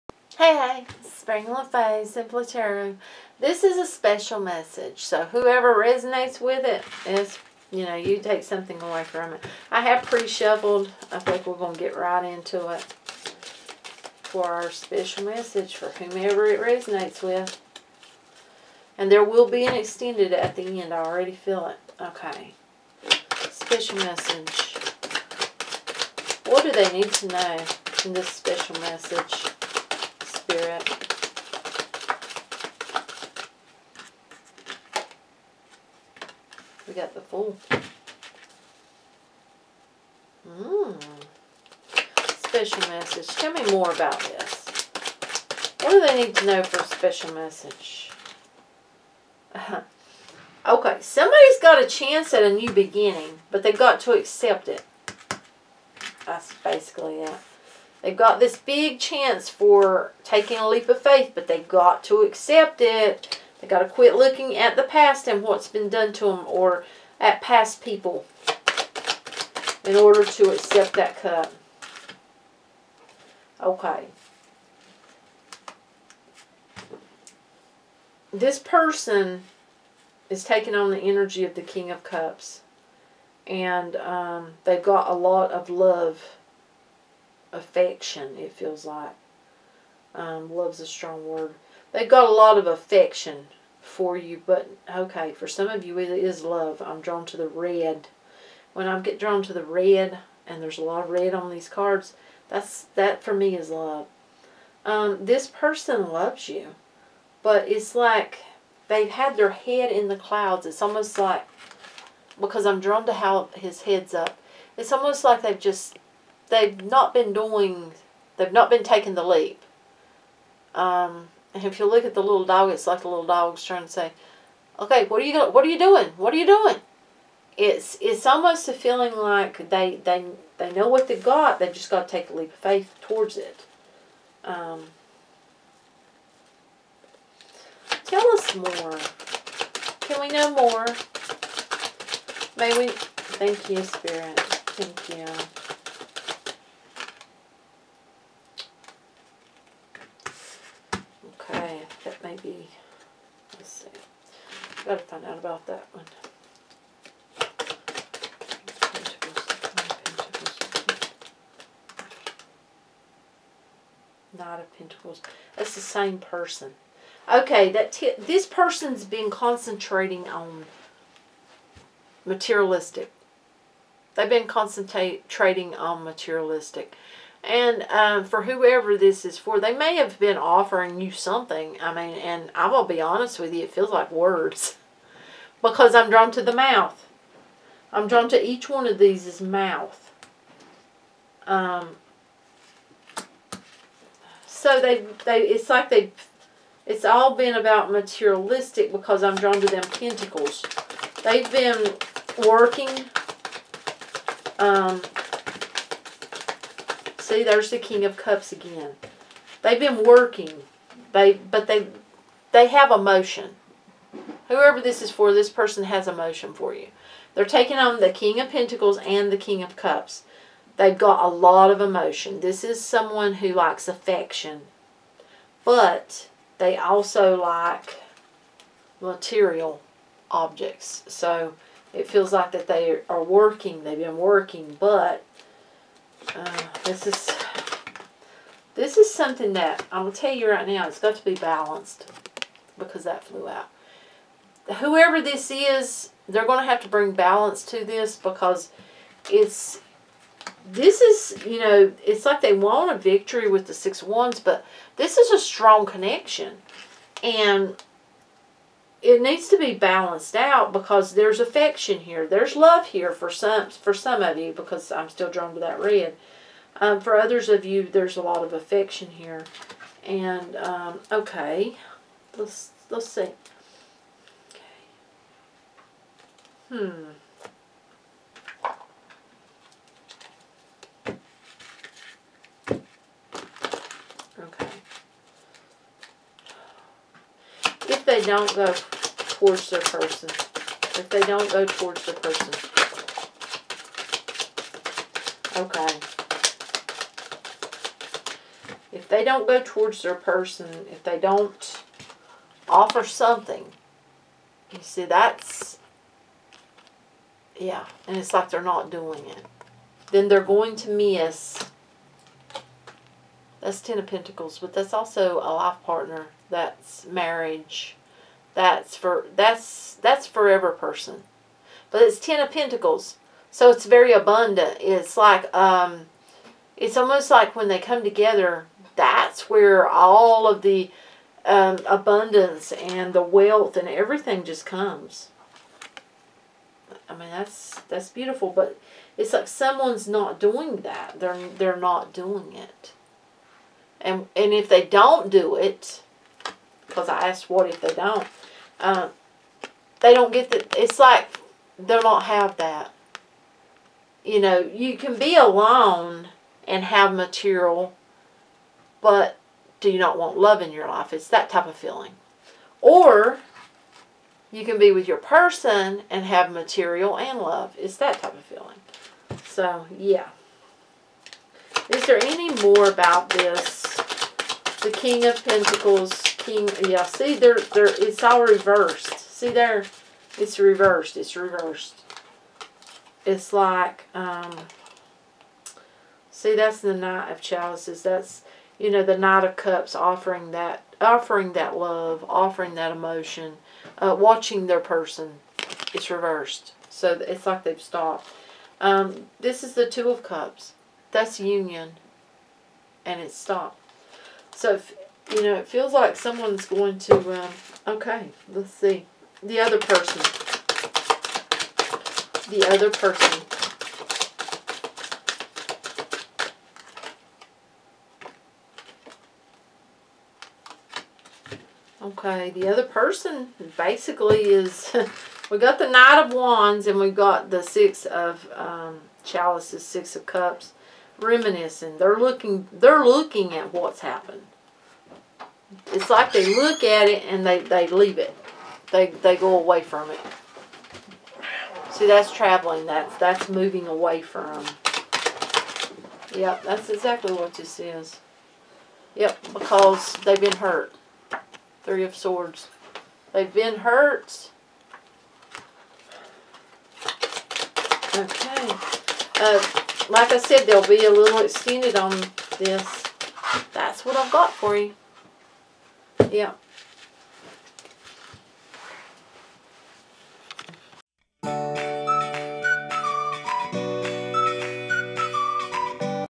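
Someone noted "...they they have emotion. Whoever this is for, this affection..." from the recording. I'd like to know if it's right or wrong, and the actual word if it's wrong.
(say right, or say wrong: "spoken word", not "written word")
wrong: "person", not "affection".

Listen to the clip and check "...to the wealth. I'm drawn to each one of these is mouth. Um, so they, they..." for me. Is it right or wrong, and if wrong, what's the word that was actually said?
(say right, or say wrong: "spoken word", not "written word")
wrong: "mouth", not "wealth".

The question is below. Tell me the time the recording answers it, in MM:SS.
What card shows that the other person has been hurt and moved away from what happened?
07:31.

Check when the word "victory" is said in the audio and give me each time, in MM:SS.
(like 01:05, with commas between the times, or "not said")
04:12.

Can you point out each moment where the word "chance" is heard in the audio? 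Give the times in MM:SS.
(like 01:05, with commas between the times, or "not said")
00:51, 00:59.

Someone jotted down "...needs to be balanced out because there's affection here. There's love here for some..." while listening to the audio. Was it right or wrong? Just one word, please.
right.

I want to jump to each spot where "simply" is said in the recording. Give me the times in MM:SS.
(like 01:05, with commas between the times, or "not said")
not said.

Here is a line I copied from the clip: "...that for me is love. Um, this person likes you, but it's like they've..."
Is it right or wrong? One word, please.
wrong.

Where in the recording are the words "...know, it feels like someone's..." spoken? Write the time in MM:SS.
06:45.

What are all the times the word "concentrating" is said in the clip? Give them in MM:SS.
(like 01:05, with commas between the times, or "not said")
02:49, 02:54.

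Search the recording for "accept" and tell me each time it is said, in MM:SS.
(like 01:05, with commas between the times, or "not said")
00:54, 01:02, 01:10.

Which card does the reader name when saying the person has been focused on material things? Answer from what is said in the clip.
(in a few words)
Knight of Pentacles.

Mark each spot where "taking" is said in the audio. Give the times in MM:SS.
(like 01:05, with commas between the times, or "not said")
01:00, 01:20, 01:58, 03:37.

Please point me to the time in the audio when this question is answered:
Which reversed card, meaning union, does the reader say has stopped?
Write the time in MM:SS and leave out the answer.
06:39.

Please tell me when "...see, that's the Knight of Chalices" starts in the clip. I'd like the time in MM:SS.
06:26.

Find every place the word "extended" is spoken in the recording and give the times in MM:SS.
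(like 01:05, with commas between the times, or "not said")
00:19, 07:41.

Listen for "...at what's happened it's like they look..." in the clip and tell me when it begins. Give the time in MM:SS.
07:13.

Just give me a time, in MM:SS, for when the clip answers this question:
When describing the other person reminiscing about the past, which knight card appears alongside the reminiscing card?
07:05.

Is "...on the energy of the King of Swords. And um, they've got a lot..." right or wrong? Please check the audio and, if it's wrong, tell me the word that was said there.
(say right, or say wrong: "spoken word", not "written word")
wrong: "Cups", not "Swords".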